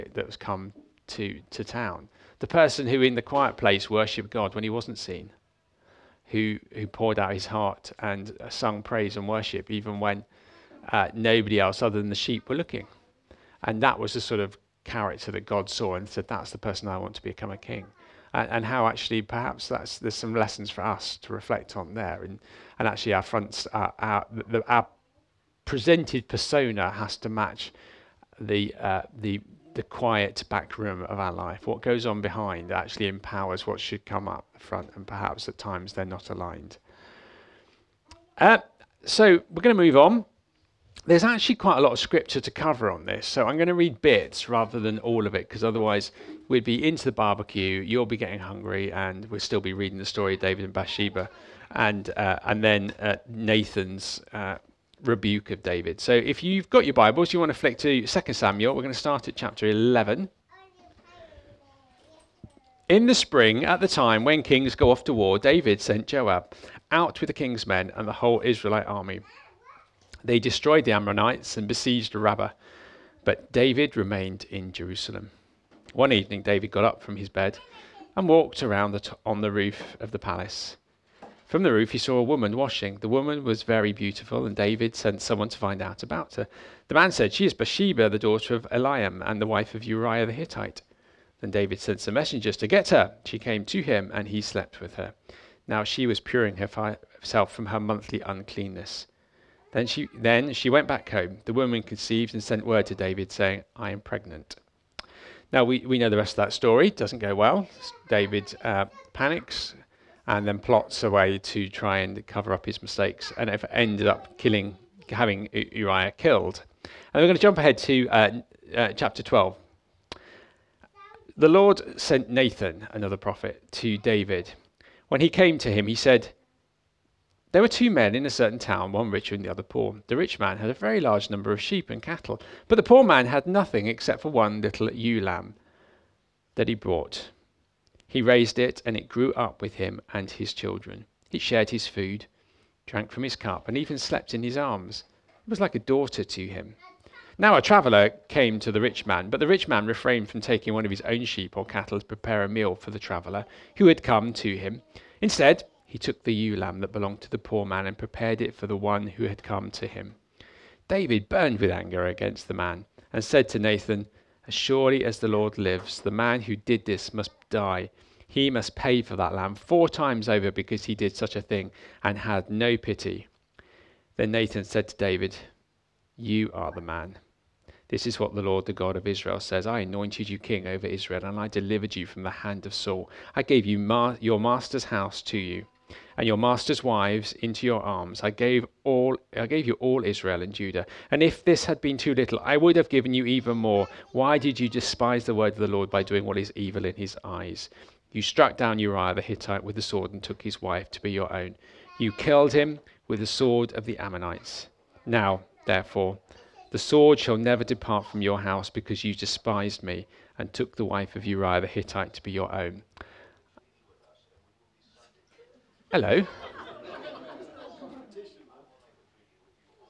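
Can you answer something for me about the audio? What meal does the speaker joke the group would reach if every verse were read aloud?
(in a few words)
barbecue.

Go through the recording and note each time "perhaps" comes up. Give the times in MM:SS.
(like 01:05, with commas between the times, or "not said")
00:19, 00:35.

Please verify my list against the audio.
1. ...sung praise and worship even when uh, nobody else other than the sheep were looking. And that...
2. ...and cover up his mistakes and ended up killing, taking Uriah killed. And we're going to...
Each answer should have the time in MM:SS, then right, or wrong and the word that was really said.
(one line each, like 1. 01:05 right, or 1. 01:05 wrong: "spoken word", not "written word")
1. 00:08 right
2. 01:51 wrong: "having", not "taking".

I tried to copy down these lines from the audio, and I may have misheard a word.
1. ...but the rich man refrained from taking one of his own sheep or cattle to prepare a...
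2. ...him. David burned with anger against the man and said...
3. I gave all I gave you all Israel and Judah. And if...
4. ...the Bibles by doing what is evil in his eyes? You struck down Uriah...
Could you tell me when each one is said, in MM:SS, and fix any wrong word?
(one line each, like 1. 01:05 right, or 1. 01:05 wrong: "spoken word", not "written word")
1. 02:29 right
2. 02:39 right
3. 03:08 right
4. 03:15 wrong: "Lord", not "Bibles".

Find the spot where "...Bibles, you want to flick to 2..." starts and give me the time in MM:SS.
00:56.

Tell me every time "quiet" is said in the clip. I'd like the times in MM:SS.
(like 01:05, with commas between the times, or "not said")
00:03, 00:29.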